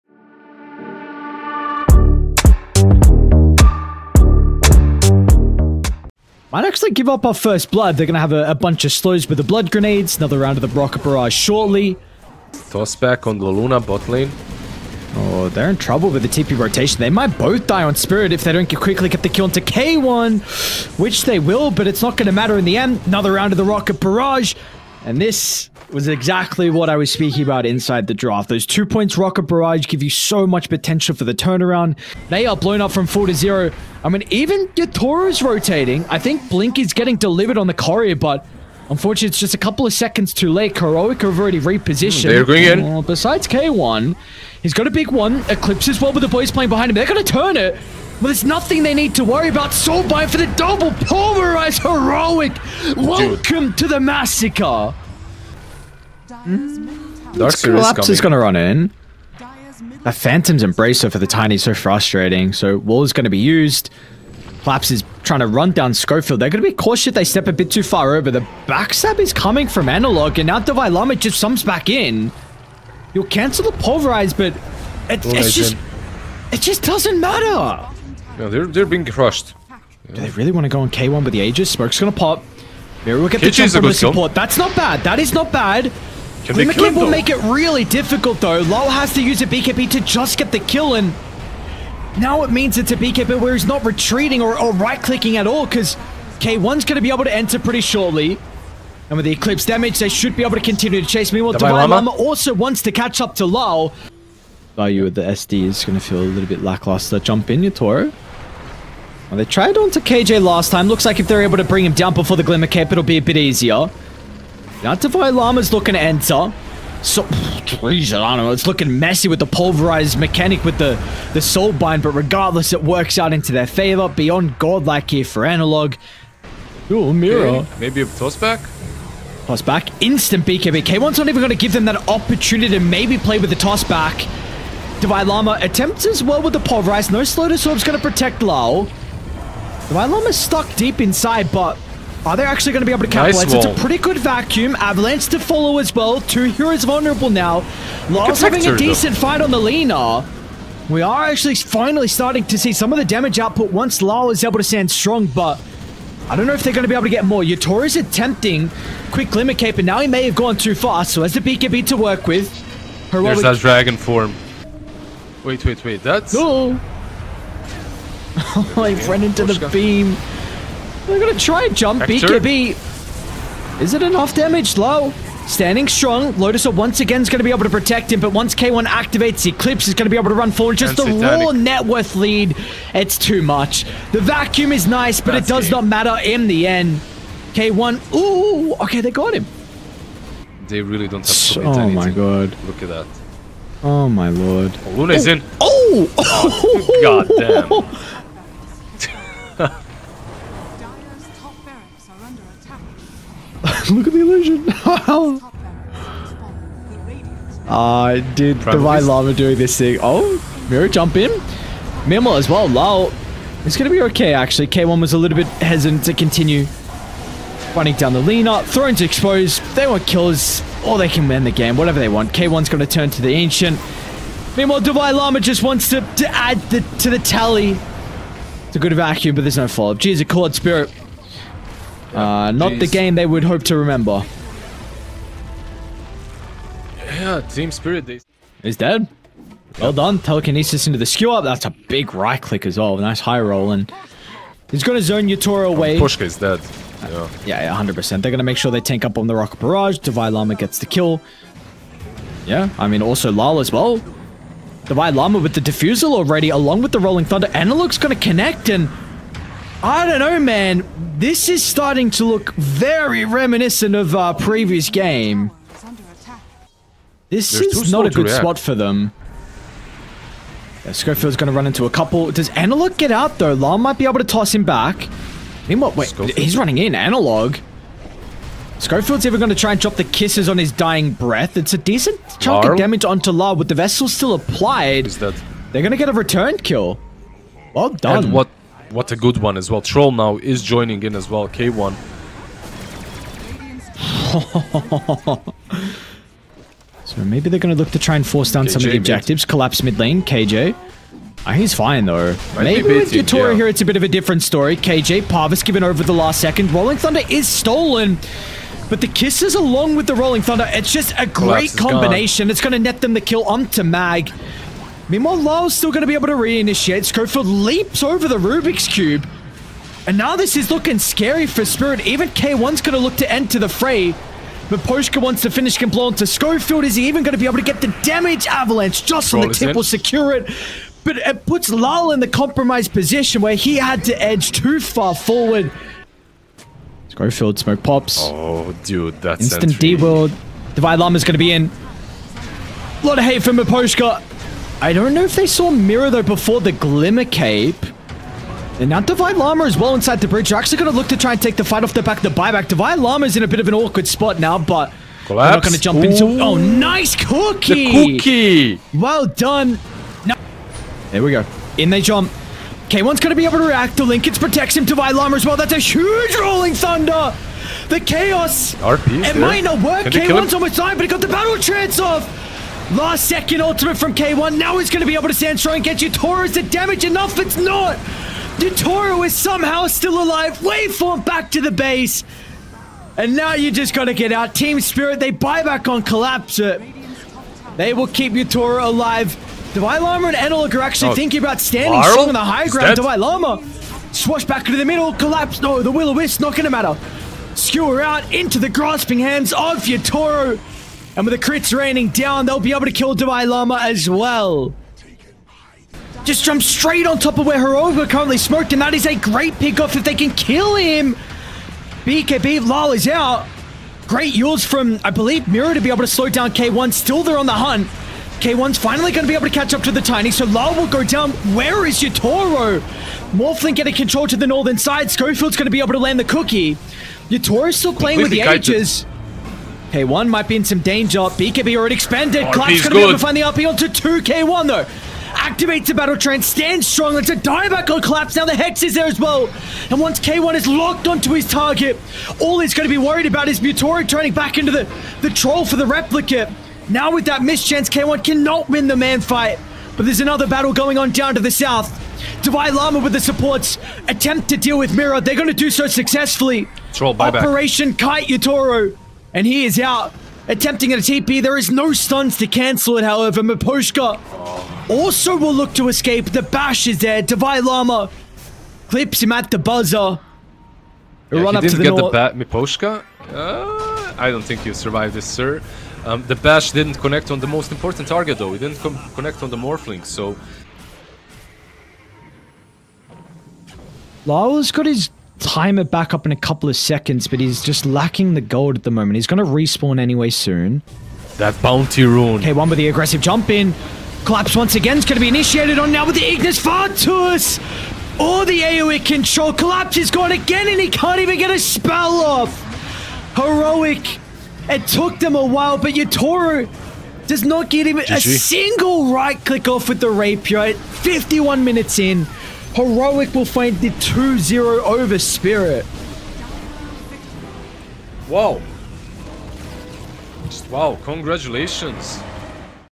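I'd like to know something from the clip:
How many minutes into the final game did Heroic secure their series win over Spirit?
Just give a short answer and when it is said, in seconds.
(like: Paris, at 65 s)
51, at 510 s.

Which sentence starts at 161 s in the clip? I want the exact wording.
So has the BKB to work with, heroic...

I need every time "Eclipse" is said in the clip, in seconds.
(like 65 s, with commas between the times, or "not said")
45 s, 99 s, 179 s.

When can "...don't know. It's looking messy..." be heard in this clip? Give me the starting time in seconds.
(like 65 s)
118 s.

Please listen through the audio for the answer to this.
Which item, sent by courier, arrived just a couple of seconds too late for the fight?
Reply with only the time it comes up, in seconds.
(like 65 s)
36 s.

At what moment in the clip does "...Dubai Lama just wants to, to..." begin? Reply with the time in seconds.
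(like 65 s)
224 s.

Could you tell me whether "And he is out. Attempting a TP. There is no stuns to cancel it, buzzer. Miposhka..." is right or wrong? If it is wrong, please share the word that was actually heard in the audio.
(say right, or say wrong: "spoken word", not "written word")
wrong: "however", not "buzzer".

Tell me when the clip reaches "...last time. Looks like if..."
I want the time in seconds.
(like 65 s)
110 s.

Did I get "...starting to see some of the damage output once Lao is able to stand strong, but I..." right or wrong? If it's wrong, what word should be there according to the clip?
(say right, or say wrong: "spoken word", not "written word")
right.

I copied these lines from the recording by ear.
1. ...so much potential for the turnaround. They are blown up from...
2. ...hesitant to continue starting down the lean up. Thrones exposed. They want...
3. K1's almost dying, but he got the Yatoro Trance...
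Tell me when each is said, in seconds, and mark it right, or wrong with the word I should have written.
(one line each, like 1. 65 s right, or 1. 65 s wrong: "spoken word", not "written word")
1. 30 s right
2. 215 s wrong: "running", not "starting"
3. 370 s wrong: "Battle", not "Yatoro".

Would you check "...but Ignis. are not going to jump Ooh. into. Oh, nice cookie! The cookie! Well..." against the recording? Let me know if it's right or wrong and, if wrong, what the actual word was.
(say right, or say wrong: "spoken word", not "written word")
wrong: "Collapse", not "Ignis".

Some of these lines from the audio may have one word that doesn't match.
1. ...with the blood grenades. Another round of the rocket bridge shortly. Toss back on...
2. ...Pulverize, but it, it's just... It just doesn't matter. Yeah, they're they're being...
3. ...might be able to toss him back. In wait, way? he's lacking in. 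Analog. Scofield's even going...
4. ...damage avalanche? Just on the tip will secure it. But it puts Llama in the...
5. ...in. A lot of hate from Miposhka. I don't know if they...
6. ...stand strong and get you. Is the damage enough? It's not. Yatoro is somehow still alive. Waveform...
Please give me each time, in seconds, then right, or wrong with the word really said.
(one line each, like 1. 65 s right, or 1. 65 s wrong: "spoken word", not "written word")
1. 9 s wrong: "barrage", not "bridge"
2. 73 s right
3. 273 s wrong: "running", not "lacking"
4. 328 s wrong: "Larl", not "Llama"
5. 341 s right
6. 375 s right.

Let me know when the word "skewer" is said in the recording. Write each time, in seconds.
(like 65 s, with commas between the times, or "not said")
241 s, 397 s.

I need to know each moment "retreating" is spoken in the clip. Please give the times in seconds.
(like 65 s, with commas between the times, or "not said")
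93 s.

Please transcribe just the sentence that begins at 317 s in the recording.
Scofield leaps over the Rubik's Cube.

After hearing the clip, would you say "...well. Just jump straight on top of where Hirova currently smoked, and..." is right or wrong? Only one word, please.
right.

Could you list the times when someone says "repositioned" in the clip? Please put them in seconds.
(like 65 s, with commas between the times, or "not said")
41 s.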